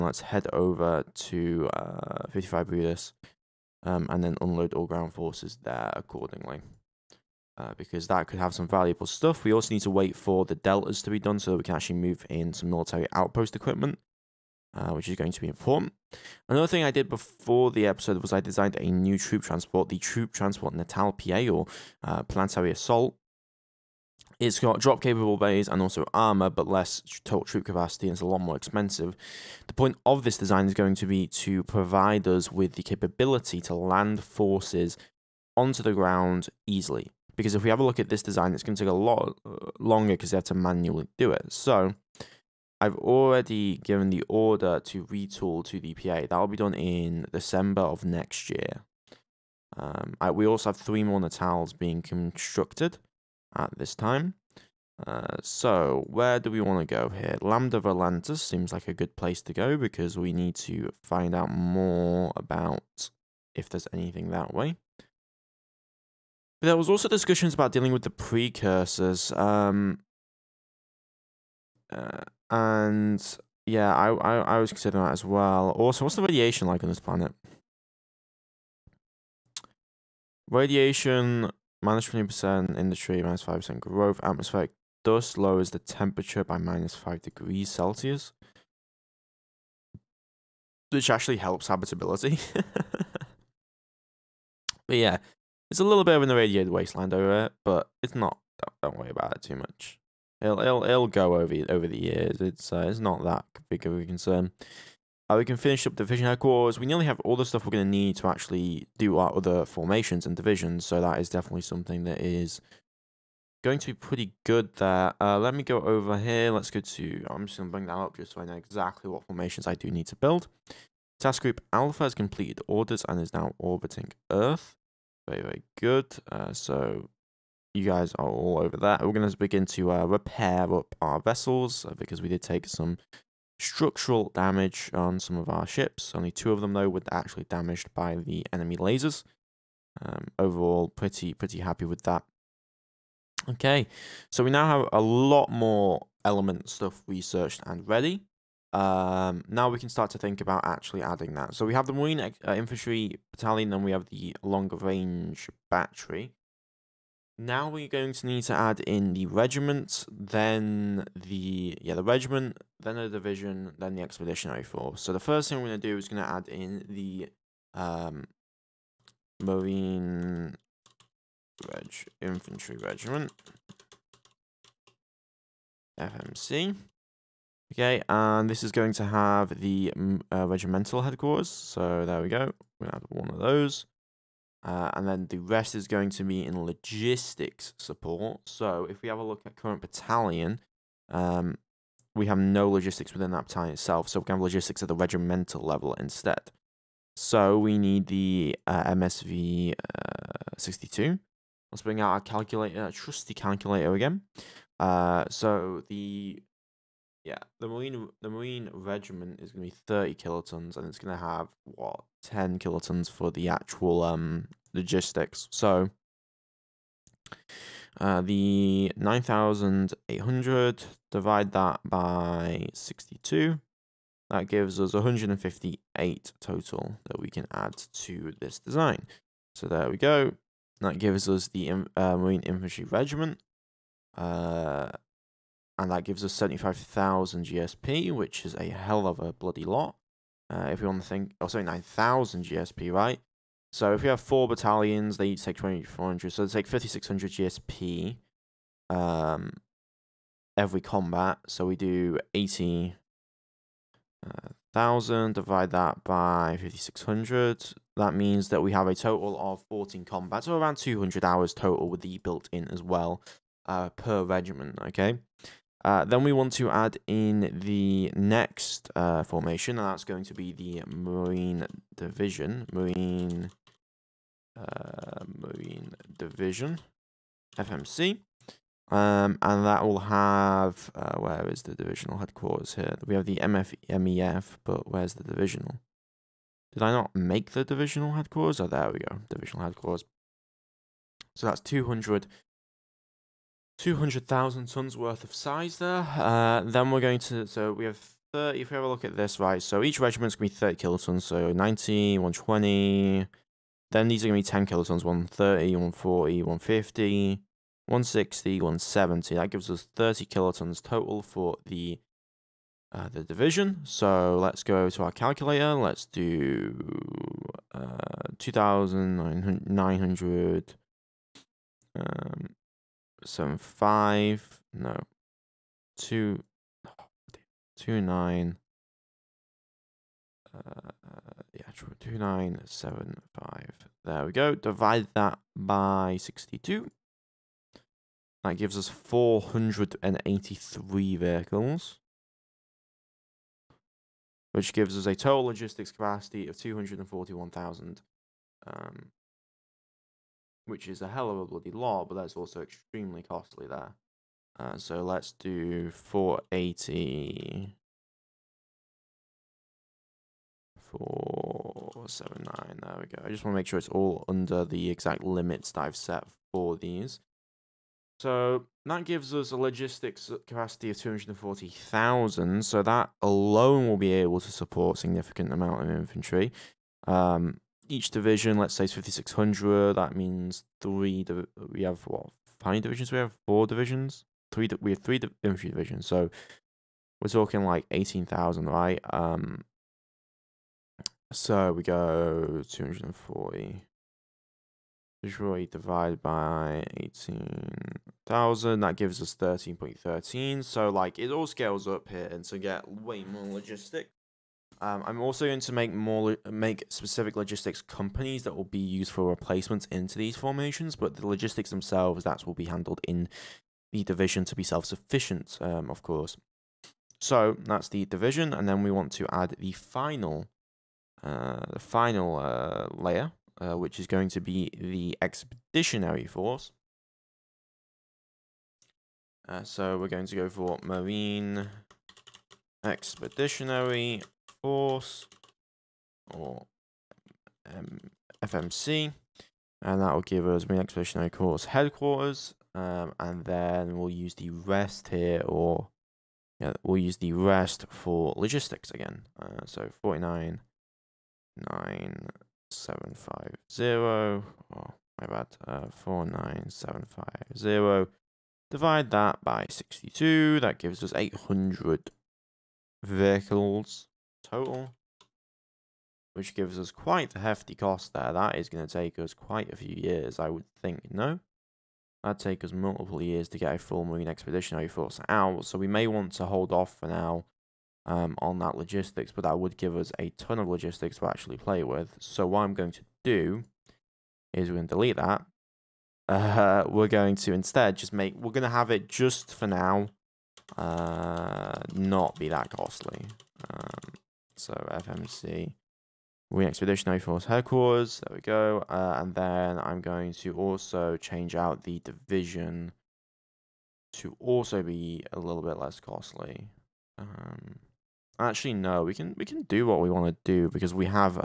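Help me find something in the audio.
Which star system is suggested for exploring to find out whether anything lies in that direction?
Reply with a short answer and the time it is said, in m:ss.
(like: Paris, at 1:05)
Lambda Volantis, at 0:57.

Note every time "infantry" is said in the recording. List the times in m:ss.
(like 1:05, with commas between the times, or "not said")
2:32, 2:52, 3:52, 6:15, 6:25.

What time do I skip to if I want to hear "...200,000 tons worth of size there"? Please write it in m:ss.
4:53.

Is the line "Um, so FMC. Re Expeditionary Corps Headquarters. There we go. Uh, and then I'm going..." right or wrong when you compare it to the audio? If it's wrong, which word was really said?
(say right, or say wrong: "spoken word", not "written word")
wrong: "Force", not "Corps".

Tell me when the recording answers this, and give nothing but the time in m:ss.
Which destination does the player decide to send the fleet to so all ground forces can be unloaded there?
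0:02.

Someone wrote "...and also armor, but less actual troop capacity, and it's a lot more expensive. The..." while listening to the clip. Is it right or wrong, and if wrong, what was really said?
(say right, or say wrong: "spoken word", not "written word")
wrong: "total", not "actual".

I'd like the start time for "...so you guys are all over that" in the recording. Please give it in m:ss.
2:06.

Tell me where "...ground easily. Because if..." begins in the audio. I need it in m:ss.
0:35.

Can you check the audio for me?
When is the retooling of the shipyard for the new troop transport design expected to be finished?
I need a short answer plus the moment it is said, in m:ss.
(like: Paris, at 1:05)
December of next year, at 0:47.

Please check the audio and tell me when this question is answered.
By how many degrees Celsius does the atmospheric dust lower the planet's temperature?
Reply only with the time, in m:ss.
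1:26.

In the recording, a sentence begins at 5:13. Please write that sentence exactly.
So let's go to our calculator.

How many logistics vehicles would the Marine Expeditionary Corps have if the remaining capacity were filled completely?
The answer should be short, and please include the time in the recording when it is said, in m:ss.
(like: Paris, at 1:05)
800, at 7:41.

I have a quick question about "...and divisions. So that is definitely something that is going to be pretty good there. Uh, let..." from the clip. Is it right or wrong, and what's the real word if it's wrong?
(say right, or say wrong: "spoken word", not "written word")
right.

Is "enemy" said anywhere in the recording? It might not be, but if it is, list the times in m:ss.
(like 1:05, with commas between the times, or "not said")
2:18.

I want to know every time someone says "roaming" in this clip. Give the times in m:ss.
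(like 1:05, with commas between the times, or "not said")
not said.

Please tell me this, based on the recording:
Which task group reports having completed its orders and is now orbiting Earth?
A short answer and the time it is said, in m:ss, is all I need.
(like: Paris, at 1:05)
Task group Alpha, at 2:01.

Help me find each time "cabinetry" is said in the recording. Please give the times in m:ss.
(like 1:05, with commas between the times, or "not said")
not said.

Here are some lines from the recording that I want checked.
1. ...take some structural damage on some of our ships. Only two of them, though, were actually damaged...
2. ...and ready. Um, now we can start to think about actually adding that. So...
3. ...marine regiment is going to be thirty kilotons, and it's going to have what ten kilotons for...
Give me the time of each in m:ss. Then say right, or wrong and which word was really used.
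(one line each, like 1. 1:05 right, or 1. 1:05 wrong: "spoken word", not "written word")
1. 2:12 right
2. 2:27 right
3. 3:28 right.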